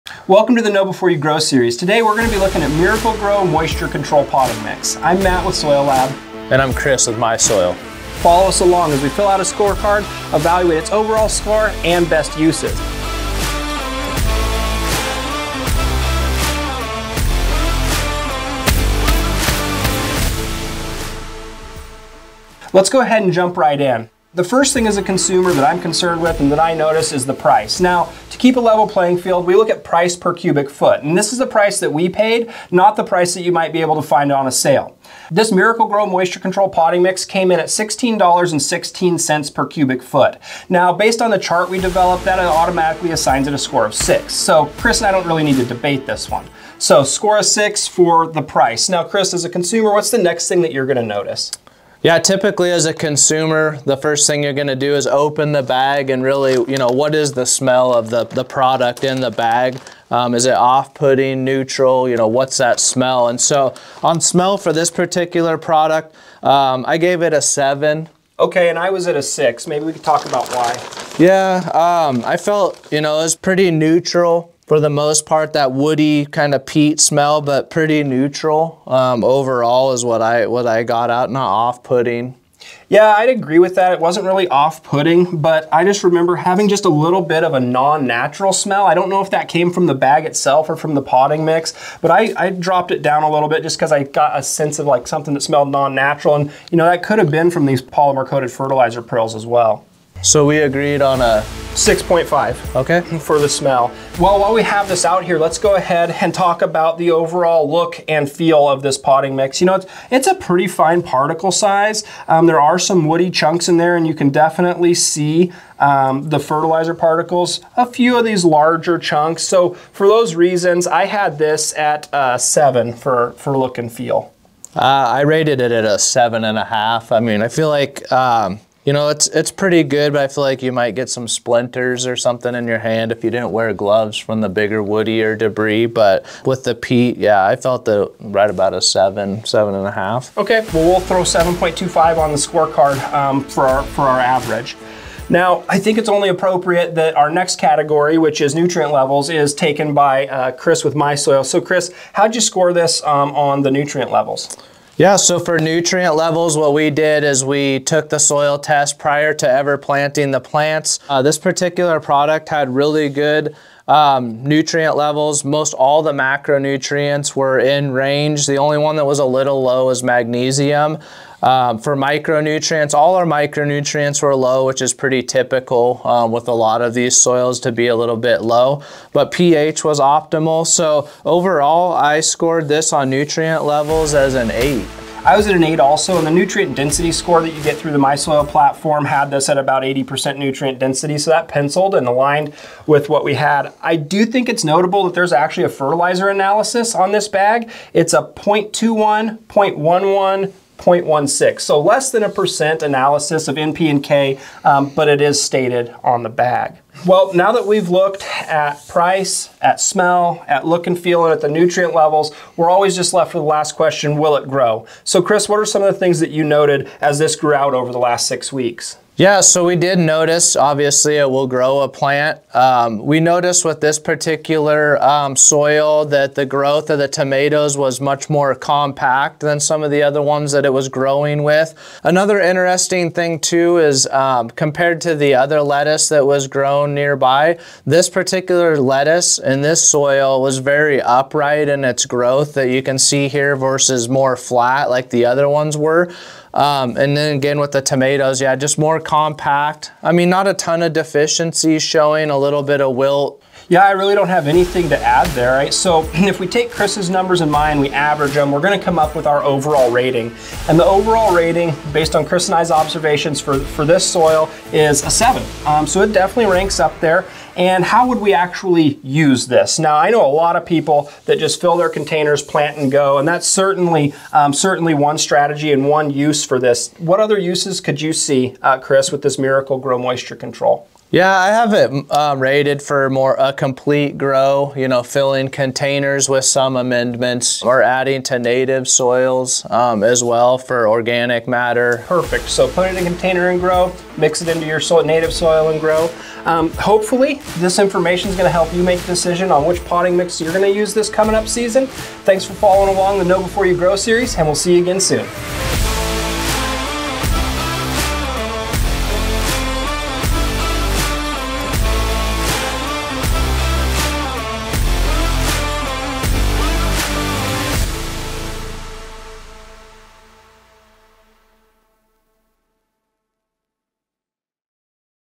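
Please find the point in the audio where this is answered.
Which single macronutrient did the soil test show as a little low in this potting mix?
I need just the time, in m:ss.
2:50.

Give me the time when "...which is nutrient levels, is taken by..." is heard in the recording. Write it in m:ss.
2:28.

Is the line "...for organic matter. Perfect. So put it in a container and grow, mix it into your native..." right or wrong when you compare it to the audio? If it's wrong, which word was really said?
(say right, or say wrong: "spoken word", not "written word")
right.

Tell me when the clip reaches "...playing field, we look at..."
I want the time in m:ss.
0:28.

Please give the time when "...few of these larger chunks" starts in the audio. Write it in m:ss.
1:57.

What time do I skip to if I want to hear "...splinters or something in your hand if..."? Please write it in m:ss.
2:11.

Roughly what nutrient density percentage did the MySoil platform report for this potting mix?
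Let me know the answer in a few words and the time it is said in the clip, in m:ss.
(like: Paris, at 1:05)
80%, at 3:09.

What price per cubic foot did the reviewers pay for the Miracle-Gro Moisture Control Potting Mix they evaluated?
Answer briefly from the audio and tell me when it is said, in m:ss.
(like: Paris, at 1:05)
$16.16, at 0:37.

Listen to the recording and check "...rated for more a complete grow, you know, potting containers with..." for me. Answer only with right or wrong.
wrong.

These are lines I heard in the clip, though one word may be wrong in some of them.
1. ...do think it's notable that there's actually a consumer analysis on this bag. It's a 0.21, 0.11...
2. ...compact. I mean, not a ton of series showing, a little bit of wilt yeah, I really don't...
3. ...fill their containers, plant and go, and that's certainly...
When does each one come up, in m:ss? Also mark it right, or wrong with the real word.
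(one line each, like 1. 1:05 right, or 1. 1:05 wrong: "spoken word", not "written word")
1. 3:13 wrong: "fertilizer", not "consumer"
2. 4:08 wrong: "deficiencies", not "series"
3. 4:31 right.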